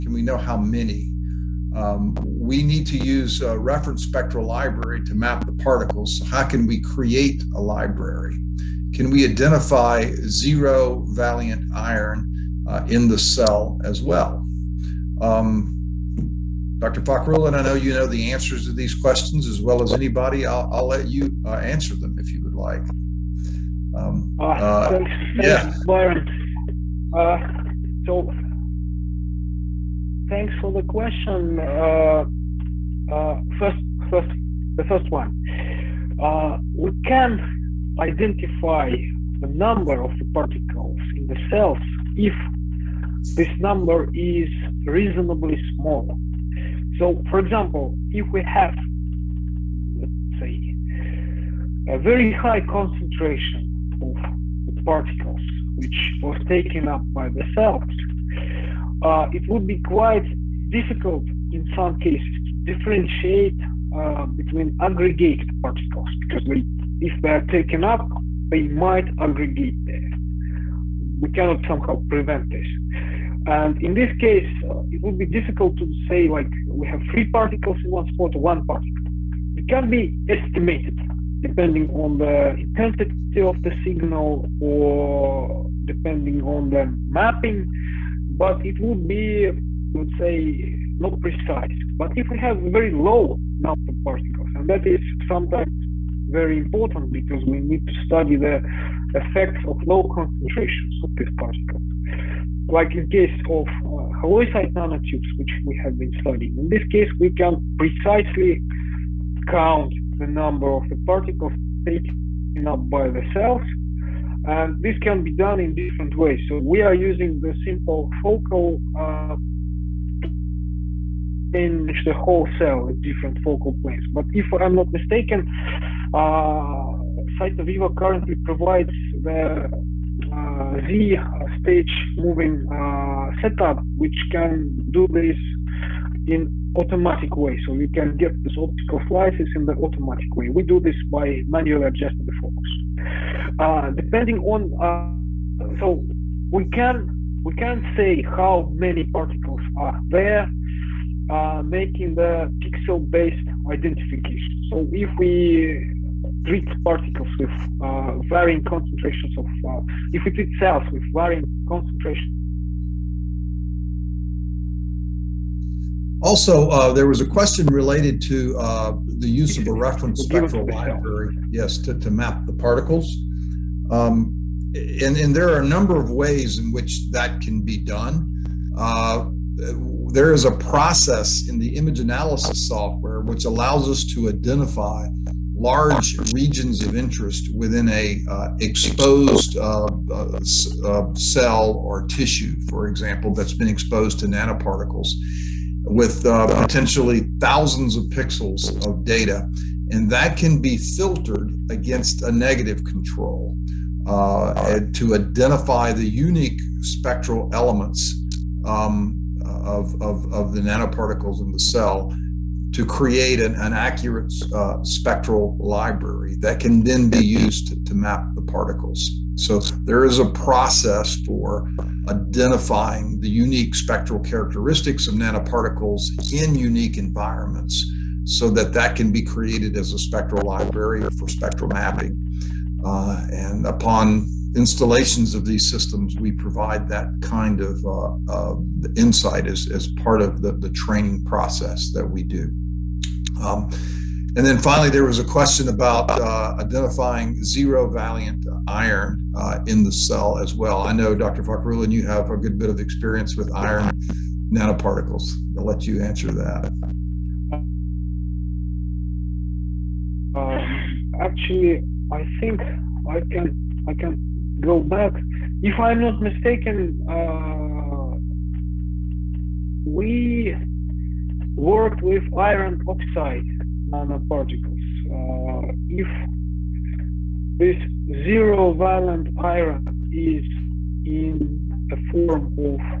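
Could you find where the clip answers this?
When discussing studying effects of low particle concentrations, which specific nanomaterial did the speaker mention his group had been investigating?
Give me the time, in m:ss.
1:44.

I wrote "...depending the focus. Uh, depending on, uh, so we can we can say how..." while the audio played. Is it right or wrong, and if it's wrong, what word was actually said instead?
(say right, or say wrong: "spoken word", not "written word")
wrong: "adjusting", not "depending".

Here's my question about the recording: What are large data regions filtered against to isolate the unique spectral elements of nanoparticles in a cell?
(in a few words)
a negative control.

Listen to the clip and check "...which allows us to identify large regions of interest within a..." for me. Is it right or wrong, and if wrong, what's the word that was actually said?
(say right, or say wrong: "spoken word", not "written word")
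right.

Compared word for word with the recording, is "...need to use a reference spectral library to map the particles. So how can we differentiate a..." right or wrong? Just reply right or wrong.
wrong.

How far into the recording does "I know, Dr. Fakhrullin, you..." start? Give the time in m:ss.
4:10.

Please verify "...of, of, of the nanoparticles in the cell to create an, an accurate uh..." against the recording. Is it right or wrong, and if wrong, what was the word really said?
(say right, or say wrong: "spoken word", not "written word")
right.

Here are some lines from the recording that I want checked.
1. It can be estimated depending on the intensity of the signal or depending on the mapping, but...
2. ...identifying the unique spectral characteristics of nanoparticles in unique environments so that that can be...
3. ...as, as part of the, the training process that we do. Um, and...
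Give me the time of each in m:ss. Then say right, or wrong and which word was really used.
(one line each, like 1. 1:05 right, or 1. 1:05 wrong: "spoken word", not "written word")
1. 1:19 right
2. 3:42 right
3. 3:59 right.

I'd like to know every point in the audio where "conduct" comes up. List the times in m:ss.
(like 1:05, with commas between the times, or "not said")
not said.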